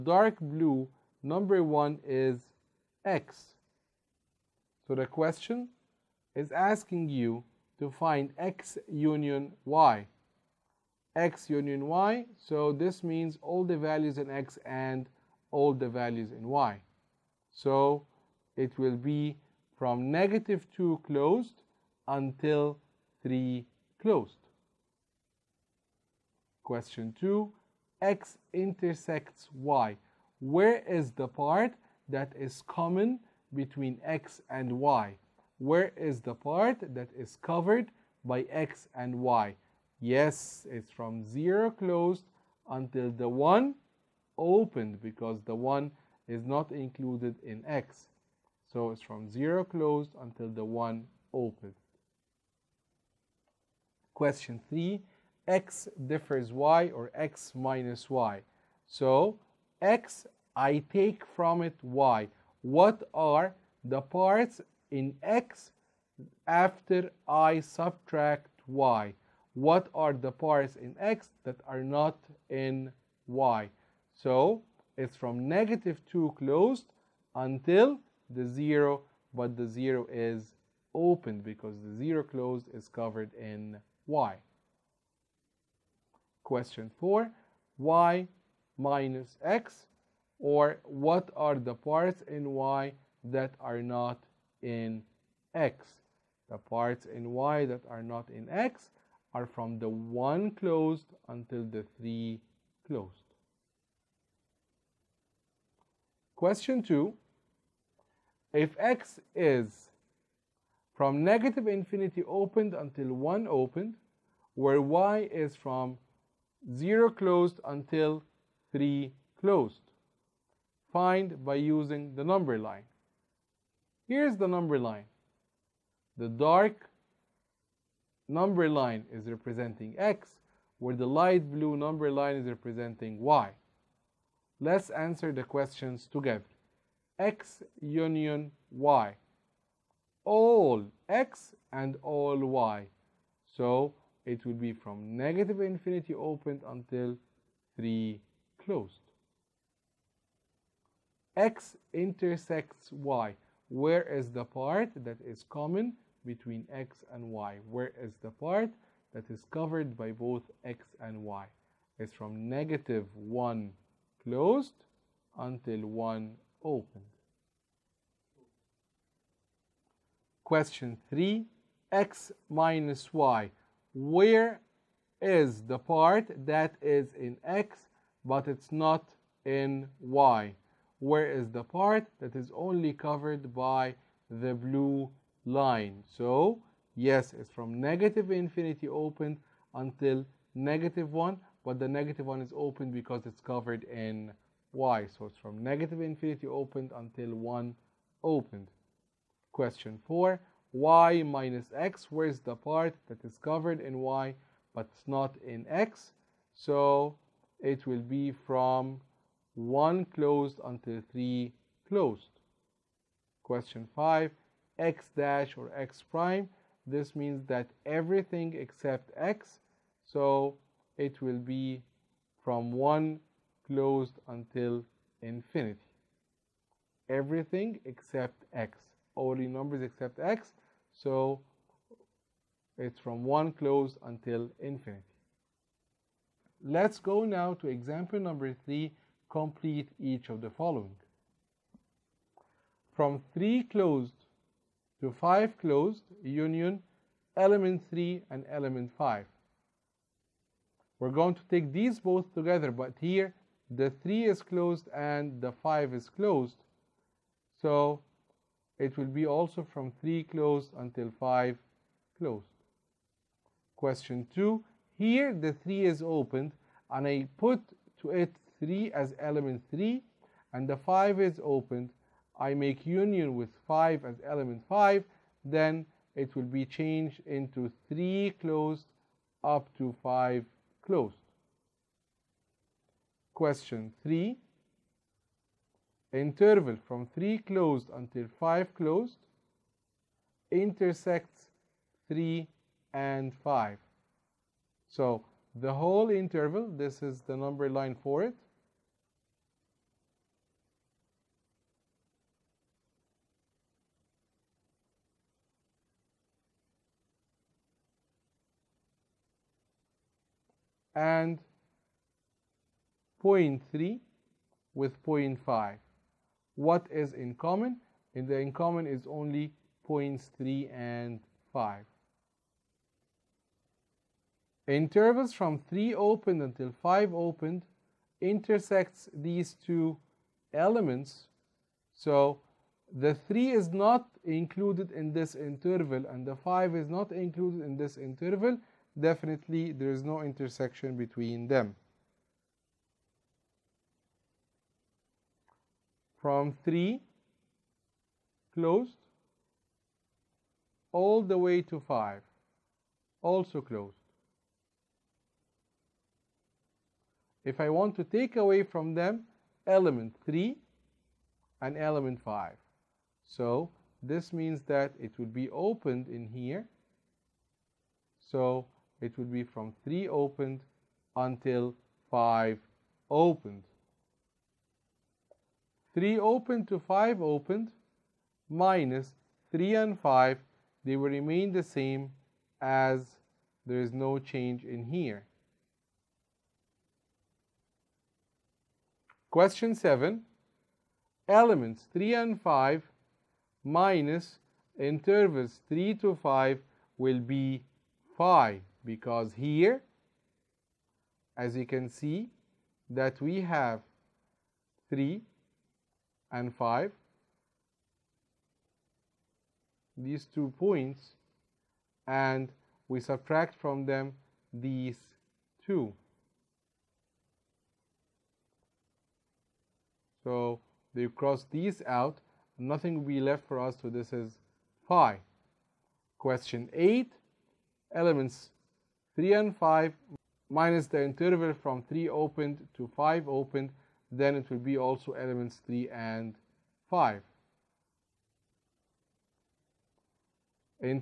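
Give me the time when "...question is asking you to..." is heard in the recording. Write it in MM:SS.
00:05.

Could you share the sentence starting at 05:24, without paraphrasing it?
Intervals from 3 opened until 5 opened intersects these two elements.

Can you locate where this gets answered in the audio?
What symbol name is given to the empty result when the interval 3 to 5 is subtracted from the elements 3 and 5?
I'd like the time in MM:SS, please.
07:04.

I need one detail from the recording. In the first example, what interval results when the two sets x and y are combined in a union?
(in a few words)
-2 closed to 3 closed.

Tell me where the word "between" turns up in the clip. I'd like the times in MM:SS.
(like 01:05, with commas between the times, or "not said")
00:33, 02:36, 05:40.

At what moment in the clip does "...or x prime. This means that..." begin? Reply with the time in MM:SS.
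03:35.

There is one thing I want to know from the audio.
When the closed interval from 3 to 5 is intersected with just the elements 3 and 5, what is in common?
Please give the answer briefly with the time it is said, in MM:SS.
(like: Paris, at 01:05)
points 3 and 5, at 05:19.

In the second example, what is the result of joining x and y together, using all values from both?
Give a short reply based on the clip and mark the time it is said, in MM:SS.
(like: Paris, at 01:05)
negative infinity to 3 closed, at 02:24.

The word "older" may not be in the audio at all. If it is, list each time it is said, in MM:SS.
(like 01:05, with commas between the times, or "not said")
not said.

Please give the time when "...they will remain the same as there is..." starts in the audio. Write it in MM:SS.
06:20.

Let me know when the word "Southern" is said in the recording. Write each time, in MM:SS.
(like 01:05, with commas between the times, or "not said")
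not said.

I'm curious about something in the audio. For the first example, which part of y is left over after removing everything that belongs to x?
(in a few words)
1 closed to 3 closed.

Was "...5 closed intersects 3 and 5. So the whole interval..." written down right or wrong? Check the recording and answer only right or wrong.
right.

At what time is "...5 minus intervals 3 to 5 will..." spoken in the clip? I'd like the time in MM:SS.
06:32.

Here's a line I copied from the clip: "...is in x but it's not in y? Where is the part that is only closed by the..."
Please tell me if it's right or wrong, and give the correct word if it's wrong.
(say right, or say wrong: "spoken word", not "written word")
wrong: "covered", not "closed".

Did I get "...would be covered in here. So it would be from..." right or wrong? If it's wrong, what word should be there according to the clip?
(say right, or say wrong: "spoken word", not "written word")
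wrong: "opened", not "covered".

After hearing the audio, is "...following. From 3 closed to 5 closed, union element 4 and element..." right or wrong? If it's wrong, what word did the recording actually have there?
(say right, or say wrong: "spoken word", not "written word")
wrong: "3", not "4".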